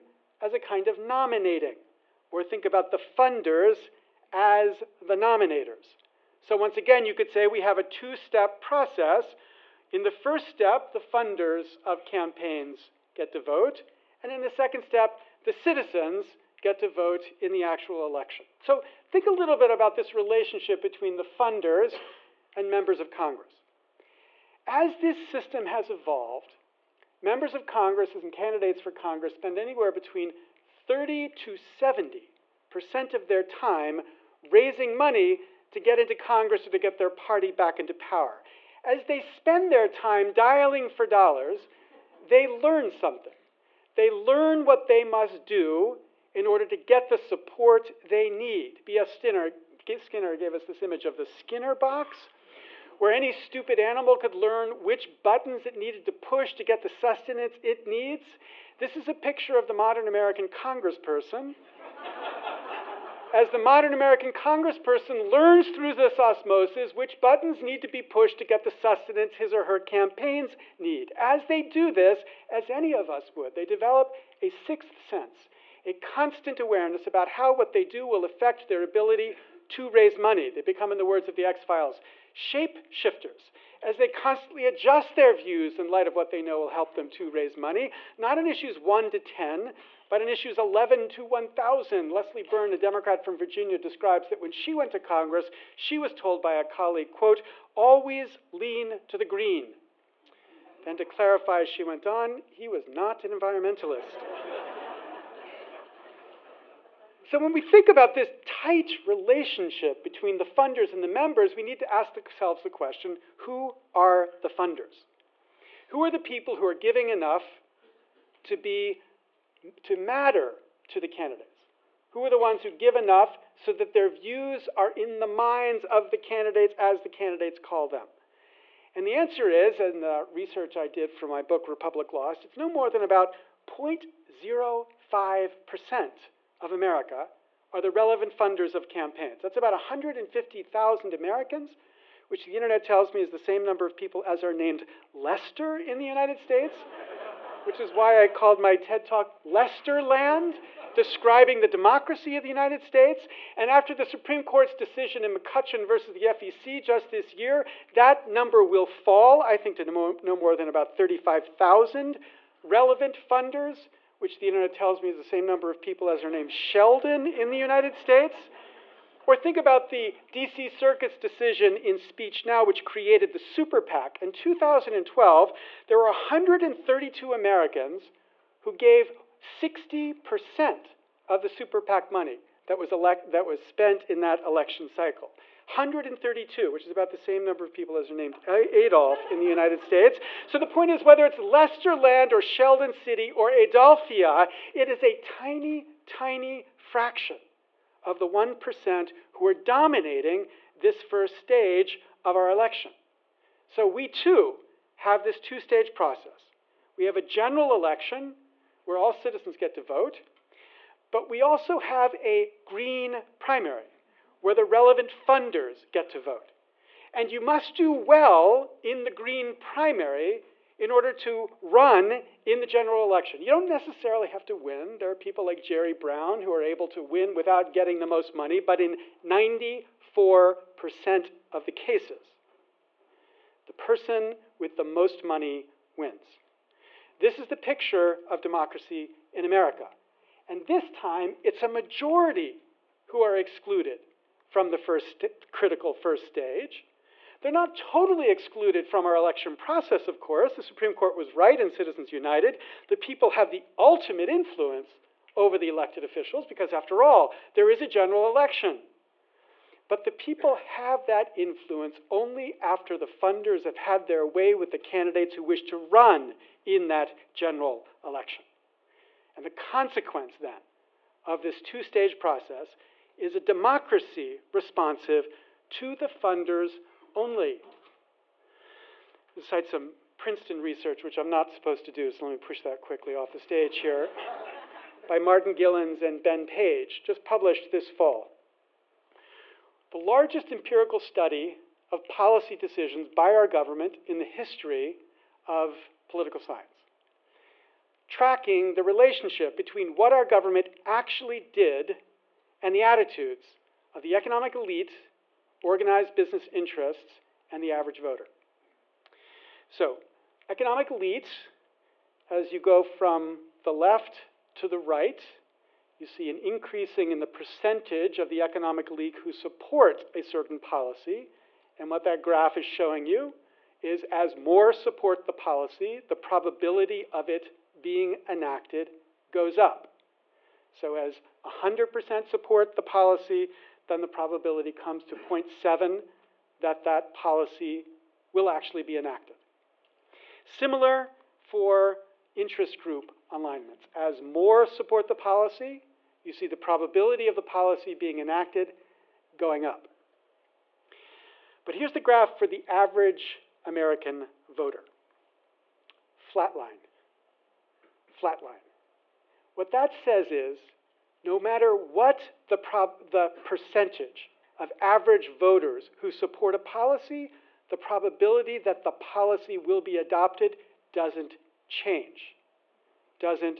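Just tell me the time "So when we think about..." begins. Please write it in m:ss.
1:47.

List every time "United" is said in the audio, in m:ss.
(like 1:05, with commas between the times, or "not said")
2:26, 2:32, 2:47, 3:09, 4:12.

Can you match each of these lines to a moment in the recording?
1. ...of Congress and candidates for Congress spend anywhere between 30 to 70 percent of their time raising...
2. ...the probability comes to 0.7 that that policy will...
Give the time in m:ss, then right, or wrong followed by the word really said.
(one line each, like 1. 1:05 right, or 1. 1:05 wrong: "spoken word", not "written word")
1. 0:27 right
2. 5:33 right.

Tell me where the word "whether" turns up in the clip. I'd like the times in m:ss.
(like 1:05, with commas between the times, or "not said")
3:11.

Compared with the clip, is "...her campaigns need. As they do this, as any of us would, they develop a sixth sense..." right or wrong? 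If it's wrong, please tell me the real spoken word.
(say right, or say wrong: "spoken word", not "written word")
right.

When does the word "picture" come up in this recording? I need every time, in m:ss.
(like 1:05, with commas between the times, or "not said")
0:59, 3:57.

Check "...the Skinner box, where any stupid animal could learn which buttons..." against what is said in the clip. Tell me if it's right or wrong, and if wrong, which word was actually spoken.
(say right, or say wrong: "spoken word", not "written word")
right.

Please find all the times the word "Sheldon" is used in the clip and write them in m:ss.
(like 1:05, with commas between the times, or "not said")
2:46, 3:12.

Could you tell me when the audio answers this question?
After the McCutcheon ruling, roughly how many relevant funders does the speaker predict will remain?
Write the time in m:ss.
2:40.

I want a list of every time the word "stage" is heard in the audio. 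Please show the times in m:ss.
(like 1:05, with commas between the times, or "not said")
3:21, 3:25, 4:06, 4:31, 4:43.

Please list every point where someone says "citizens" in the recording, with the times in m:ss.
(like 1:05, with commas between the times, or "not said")
0:15, 3:29, 4:11.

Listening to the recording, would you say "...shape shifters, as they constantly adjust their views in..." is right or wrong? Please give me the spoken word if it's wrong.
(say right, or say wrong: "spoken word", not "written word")
right.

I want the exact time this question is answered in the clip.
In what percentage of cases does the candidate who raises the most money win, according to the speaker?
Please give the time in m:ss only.
3:49.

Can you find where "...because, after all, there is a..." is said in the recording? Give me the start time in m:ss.
4:16.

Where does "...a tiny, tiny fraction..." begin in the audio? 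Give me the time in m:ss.
3:15.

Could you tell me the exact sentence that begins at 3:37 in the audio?
And you must do well in the Green primary in order to run in the general election.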